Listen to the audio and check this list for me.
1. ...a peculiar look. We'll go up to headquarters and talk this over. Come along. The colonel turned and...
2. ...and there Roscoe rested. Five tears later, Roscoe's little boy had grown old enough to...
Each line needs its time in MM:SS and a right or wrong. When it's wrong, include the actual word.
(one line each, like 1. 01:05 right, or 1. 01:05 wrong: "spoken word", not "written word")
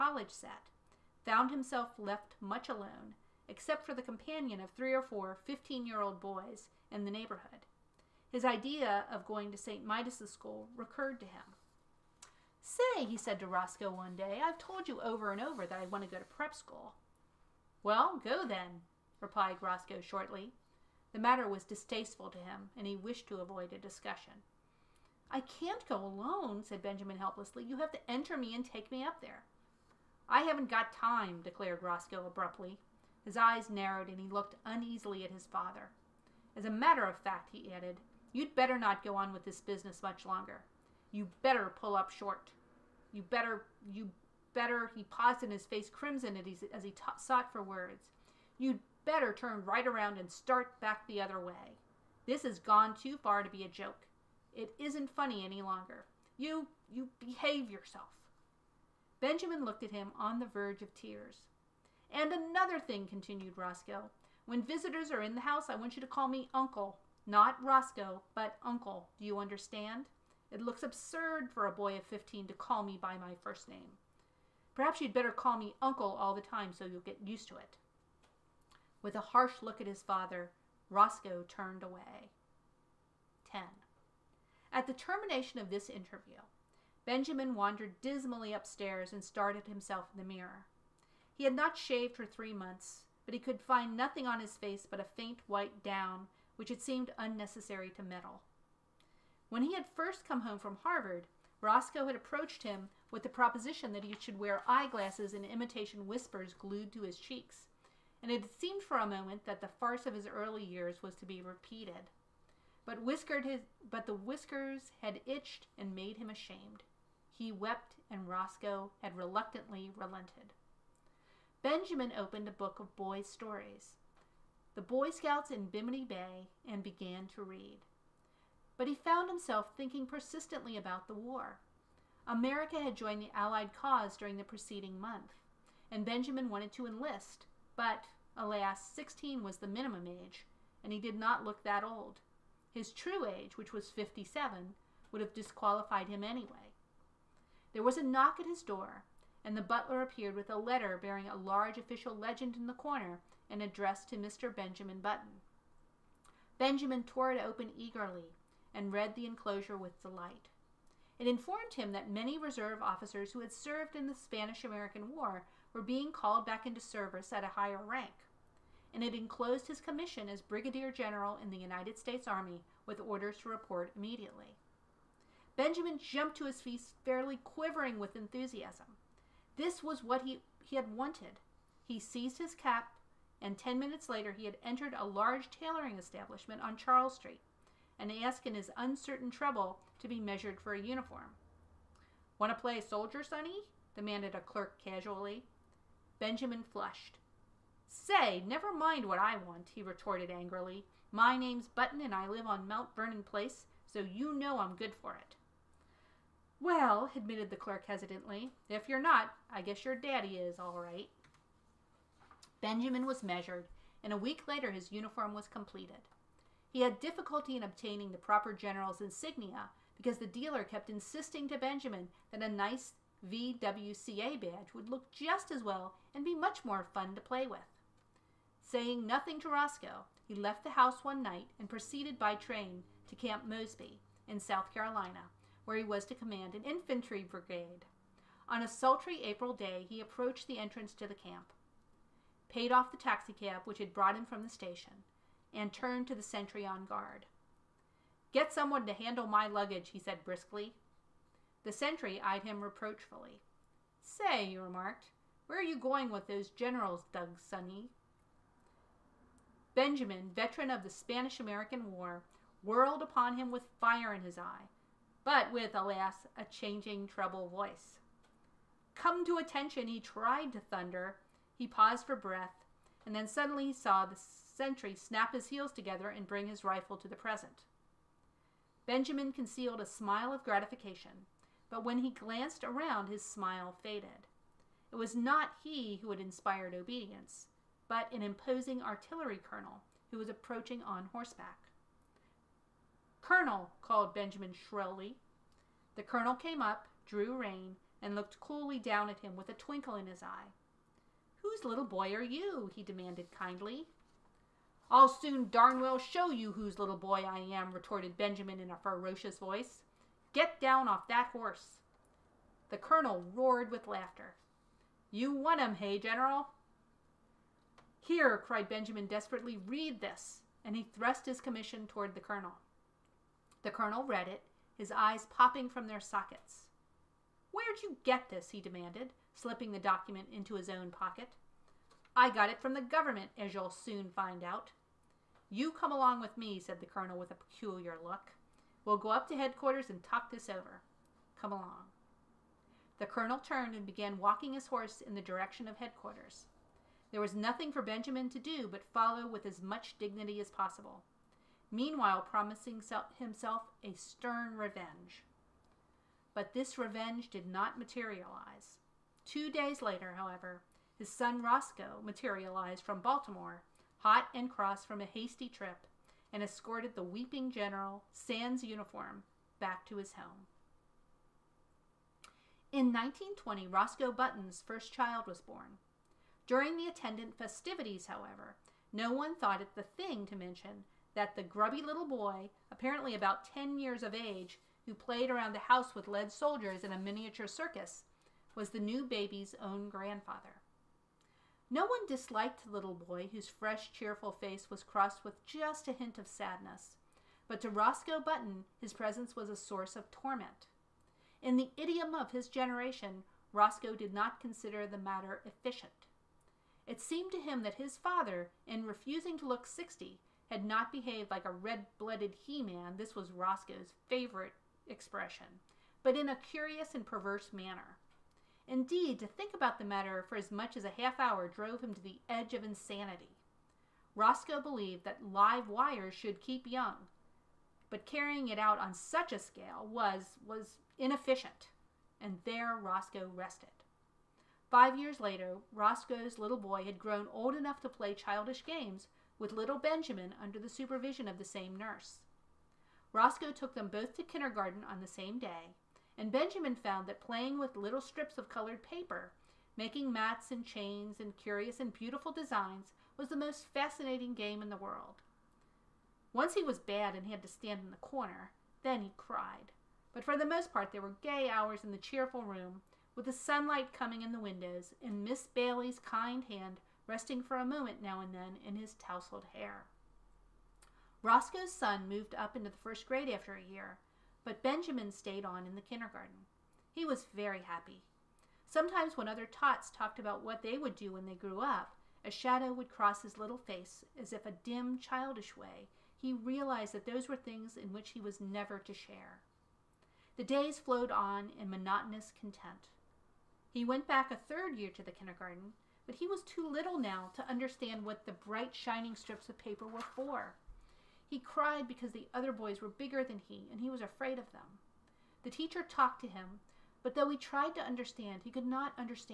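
1. 05:37 right
2. 07:12 wrong: "years", not "tears".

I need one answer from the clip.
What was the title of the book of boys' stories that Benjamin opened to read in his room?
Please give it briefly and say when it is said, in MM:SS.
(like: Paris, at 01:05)
The Boy Scouts in Bimini Bay, at 02:04.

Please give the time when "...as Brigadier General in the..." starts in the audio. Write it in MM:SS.
02:50.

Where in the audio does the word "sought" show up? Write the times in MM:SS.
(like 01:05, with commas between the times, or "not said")
00:47.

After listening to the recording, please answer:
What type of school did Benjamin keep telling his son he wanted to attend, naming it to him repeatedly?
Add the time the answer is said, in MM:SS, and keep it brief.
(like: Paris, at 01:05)
prep school, at 00:16.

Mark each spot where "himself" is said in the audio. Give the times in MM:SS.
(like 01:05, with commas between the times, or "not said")
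00:01, 01:29, 02:09, 05:53.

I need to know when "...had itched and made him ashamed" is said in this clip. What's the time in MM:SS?
01:55.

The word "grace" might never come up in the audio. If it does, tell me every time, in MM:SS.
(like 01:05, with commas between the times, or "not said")
not said.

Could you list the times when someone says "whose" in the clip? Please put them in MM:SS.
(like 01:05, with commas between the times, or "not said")
05:01, 05:06, 06:33.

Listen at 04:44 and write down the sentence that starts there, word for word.
It was not he who had inspired obedience, but an imposing artillery colonel who was approaching on horseback.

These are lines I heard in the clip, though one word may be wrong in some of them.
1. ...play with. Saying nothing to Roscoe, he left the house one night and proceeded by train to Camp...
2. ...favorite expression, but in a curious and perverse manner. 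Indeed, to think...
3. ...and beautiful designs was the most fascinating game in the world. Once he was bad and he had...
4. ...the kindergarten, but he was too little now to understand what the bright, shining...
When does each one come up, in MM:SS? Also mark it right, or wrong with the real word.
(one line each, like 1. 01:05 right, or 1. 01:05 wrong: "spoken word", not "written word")
1. 03:47 right
2. 06:54 right
3. 07:31 right
4. 08:15 right.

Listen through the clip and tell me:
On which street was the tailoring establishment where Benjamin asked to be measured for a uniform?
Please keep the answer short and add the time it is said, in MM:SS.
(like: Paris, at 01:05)
Charles Street, at 03:06.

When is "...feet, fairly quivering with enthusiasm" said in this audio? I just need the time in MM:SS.
02:56.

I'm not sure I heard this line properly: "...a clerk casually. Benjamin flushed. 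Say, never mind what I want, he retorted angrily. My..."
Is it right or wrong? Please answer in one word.
right.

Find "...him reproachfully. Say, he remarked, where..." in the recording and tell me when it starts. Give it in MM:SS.
04:12.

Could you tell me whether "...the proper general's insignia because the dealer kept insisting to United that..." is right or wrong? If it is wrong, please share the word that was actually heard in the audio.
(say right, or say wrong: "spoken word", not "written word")
wrong: "Benjamin", not "United".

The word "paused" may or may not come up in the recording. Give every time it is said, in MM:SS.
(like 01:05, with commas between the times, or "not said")
00:45, 04:31.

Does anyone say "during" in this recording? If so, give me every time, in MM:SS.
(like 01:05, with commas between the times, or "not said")
02:14, 06:16.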